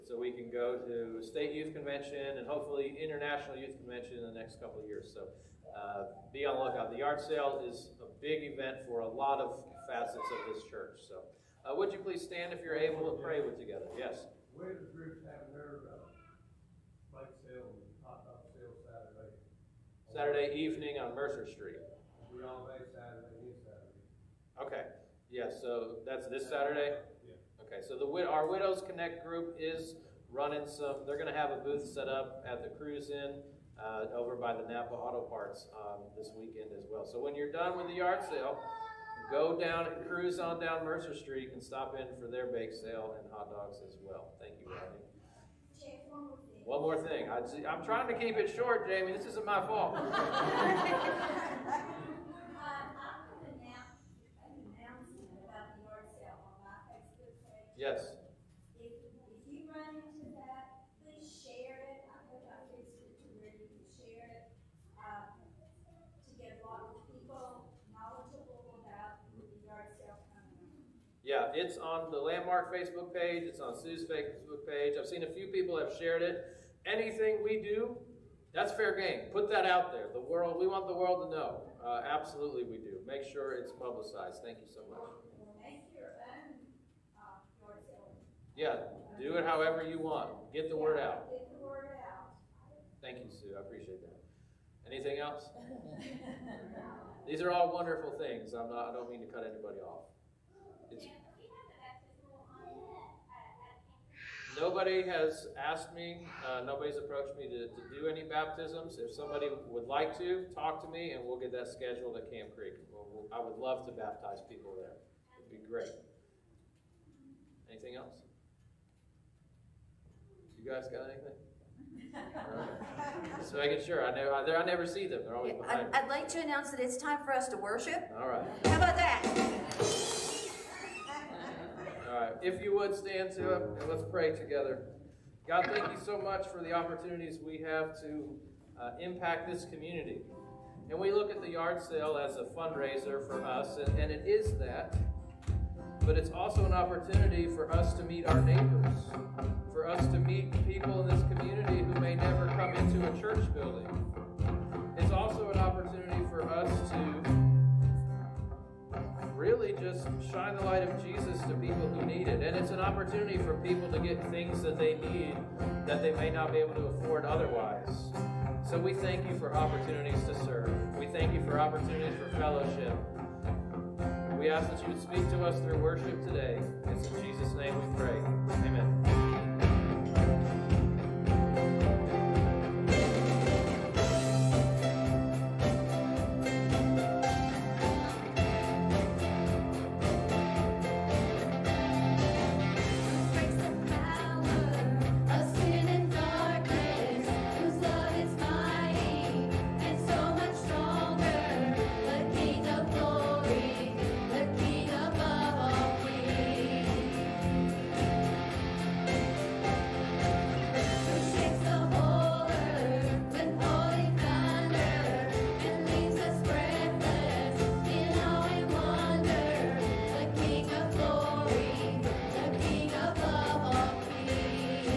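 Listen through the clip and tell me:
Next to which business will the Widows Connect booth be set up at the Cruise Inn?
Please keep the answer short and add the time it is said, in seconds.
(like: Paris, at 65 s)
Napa Auto Parts, at 34 s.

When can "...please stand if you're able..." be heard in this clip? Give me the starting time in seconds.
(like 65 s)
11 s.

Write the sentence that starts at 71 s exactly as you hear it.
Yeah, it's on the Landmark Facebook page.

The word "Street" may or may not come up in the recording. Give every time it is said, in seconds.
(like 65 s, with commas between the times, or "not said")
21 s, 41 s.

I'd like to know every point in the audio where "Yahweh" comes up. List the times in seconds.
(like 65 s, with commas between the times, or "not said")
22 s.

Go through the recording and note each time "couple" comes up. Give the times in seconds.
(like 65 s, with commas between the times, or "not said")
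4 s.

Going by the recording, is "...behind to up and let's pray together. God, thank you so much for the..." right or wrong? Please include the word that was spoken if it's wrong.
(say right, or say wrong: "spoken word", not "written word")
wrong: "stand", not "behind".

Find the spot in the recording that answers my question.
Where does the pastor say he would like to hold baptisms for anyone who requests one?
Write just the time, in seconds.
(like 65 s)
112 s.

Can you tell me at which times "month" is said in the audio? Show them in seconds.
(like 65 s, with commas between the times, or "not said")
not said.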